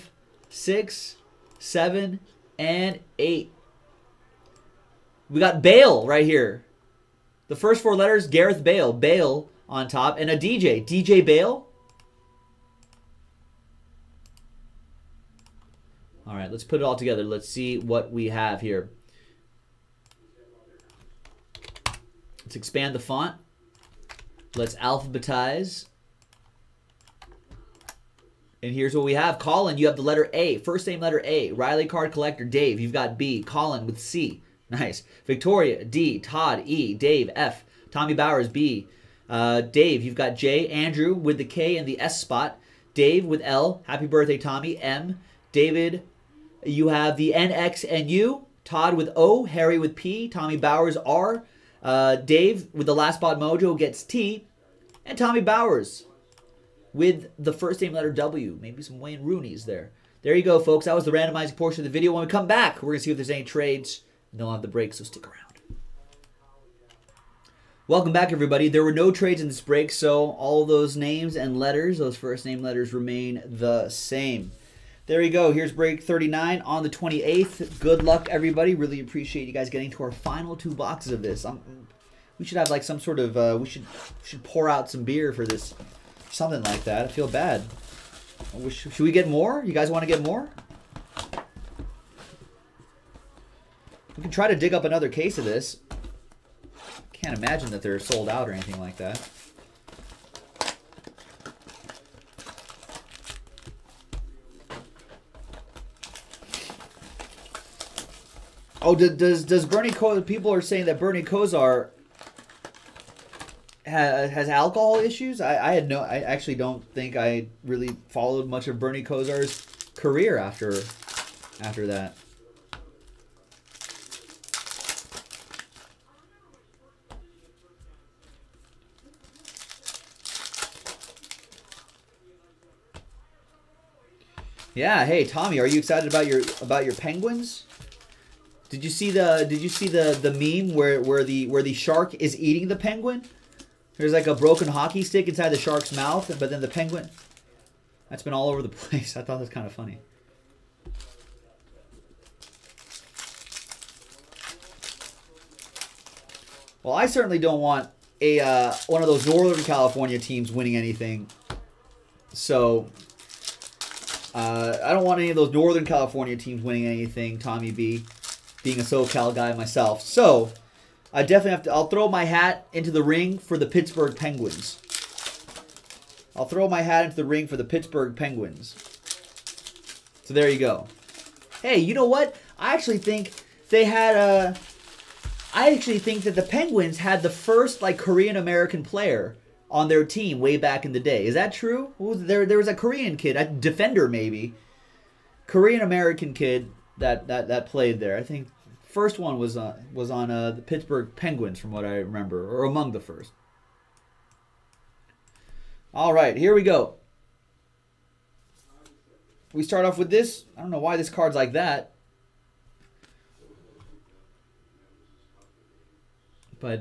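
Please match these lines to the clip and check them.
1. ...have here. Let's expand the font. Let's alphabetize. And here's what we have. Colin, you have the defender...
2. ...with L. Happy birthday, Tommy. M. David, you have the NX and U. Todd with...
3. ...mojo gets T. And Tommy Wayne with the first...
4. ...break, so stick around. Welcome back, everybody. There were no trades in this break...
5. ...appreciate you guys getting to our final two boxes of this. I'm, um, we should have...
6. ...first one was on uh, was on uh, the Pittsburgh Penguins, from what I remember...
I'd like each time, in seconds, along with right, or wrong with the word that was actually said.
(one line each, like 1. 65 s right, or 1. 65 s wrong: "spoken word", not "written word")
1. 18 s wrong: "letter", not "defender"
2. 43 s right
3. 53 s wrong: "Bowers", not "Wayne"
4. 64 s right
5. 78 s right
6. 198 s right.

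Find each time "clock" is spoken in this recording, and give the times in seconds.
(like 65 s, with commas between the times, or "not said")
not said.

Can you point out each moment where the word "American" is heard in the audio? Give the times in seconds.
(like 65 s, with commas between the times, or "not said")
188 s, 195 s.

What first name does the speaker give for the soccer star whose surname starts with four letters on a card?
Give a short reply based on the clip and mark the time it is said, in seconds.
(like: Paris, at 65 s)
Gareth, at 8 s.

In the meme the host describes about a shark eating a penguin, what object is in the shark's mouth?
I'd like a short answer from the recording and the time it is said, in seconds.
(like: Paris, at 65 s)
Broken hockey stick, at 144 s.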